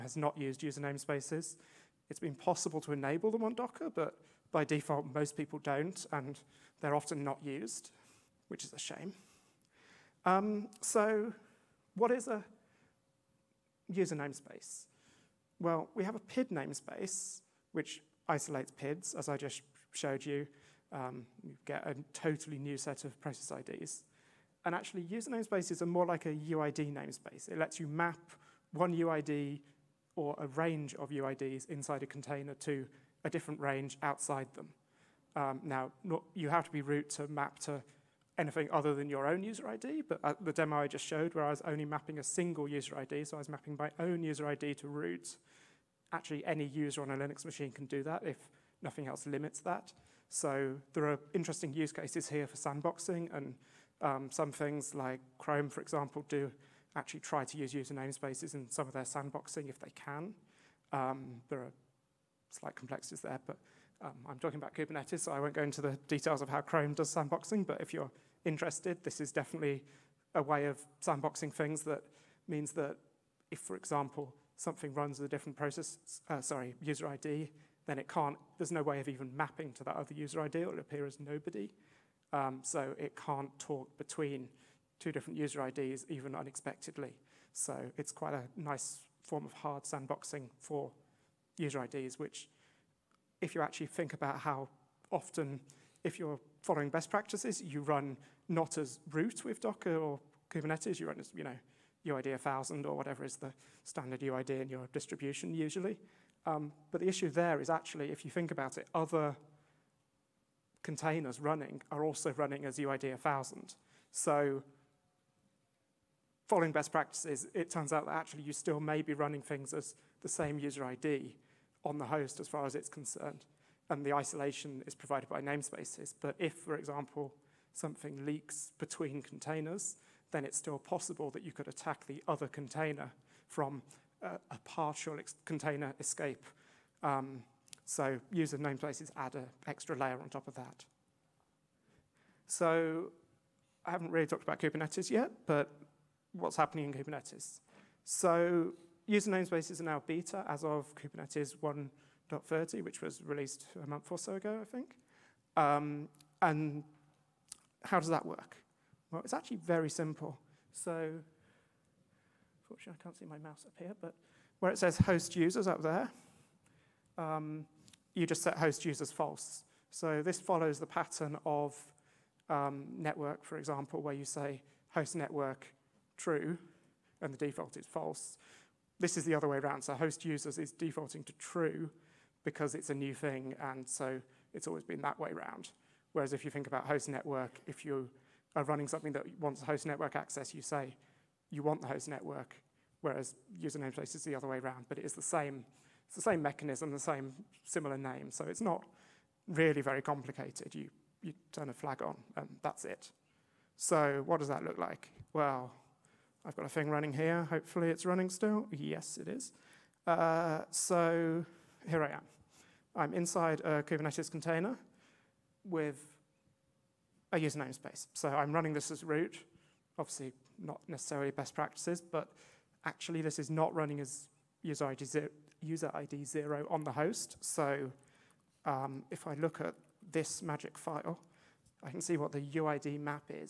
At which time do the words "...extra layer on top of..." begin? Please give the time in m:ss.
2:19.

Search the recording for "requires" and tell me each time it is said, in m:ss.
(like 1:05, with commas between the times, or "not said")
not said.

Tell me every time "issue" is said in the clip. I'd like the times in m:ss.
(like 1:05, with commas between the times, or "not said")
1:47.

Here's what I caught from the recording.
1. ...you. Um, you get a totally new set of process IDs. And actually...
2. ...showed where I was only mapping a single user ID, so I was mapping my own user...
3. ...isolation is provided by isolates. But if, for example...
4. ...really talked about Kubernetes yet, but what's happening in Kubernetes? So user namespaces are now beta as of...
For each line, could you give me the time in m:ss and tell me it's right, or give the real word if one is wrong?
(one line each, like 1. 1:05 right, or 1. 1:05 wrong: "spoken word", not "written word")
1. 0:20 right
2. 0:41 right
3. 2:04 wrong: "namespaces", not "isolates"
4. 2:24 right.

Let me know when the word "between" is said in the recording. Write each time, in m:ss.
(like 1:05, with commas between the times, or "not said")
1:23, 2:08.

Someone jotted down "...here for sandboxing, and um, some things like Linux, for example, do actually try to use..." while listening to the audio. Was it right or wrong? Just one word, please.
wrong.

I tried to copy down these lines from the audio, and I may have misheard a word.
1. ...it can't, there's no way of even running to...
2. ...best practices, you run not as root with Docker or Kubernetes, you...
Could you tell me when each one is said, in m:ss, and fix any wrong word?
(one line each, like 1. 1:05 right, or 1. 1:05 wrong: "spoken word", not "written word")
1. 1:17 wrong: "mapping", not "running"
2. 1:36 right.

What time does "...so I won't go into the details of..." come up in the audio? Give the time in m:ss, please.
1:05.